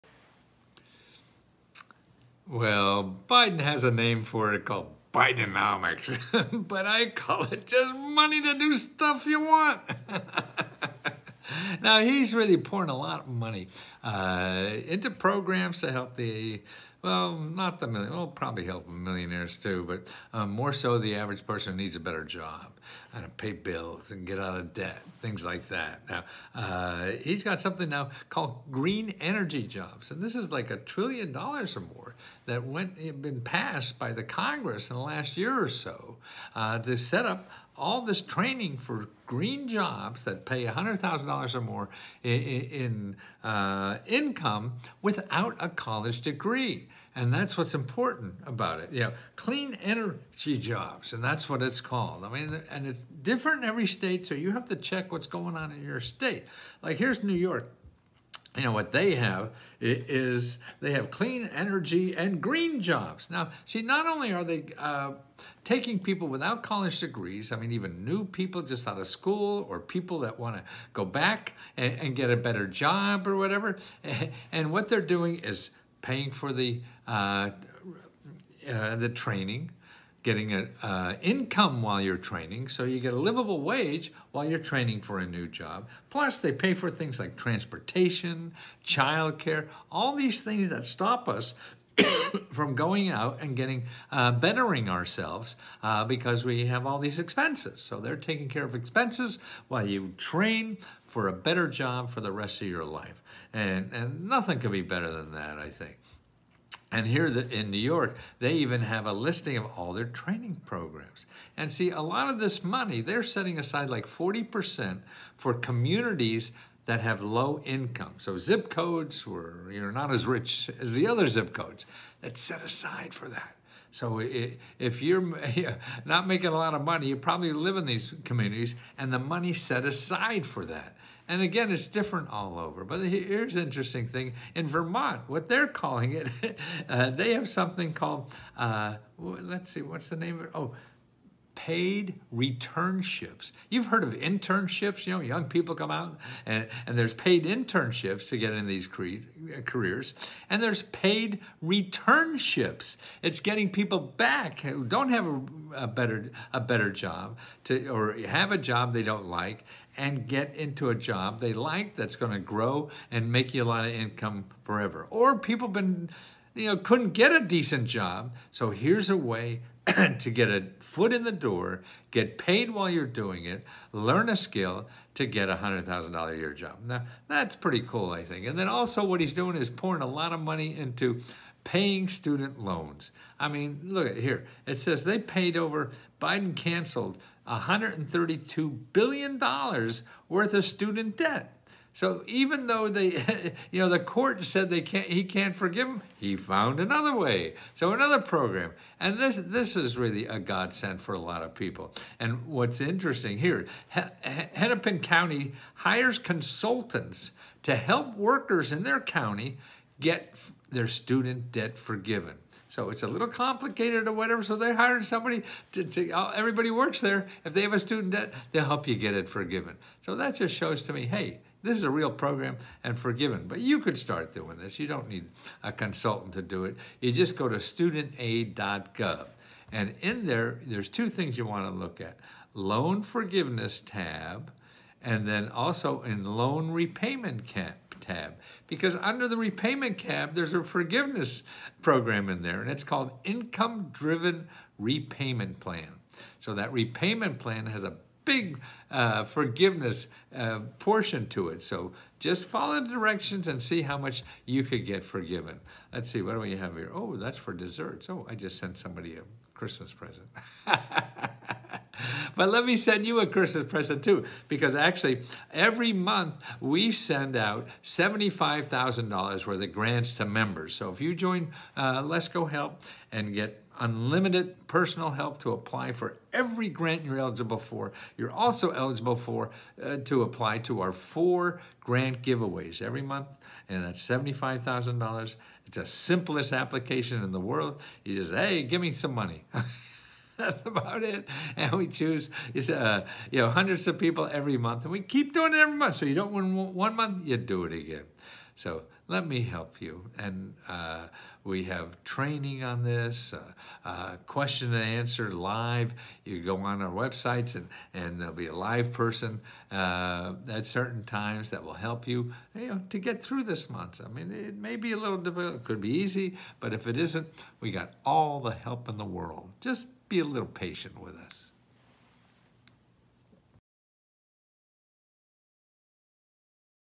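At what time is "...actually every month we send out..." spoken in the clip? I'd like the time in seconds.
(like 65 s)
264 s.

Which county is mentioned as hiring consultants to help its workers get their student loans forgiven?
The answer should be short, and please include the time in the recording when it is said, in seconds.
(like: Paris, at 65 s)
Hennepin County, at 203 s.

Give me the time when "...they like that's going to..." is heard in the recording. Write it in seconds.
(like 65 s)
161 s.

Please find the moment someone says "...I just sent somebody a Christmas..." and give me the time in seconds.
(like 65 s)
258 s.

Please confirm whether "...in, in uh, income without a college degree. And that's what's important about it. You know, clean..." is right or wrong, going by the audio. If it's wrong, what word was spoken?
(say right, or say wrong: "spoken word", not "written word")
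right.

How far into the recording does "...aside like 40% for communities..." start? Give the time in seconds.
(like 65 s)
113 s.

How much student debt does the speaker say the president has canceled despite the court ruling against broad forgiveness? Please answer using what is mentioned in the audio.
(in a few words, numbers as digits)
$132 billion.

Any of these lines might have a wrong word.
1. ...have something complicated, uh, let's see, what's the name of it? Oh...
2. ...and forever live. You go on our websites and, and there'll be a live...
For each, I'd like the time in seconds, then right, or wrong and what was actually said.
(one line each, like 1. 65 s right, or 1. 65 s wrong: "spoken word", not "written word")
1. 137 s wrong: "called", not "complicated"
2. 304 s wrong: "answer", not "forever".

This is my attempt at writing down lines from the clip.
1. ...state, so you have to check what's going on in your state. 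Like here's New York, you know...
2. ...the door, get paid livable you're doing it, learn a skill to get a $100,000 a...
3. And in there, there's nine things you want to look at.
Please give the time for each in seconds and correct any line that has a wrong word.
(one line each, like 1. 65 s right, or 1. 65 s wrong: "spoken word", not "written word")
1. 53 s right
2. 171 s wrong: "while", not "livable"
3. 229 s wrong: "two", not "nine".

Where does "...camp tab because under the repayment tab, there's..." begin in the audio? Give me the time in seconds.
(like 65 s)
237 s.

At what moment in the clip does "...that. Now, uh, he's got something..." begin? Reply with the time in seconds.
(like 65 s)
25 s.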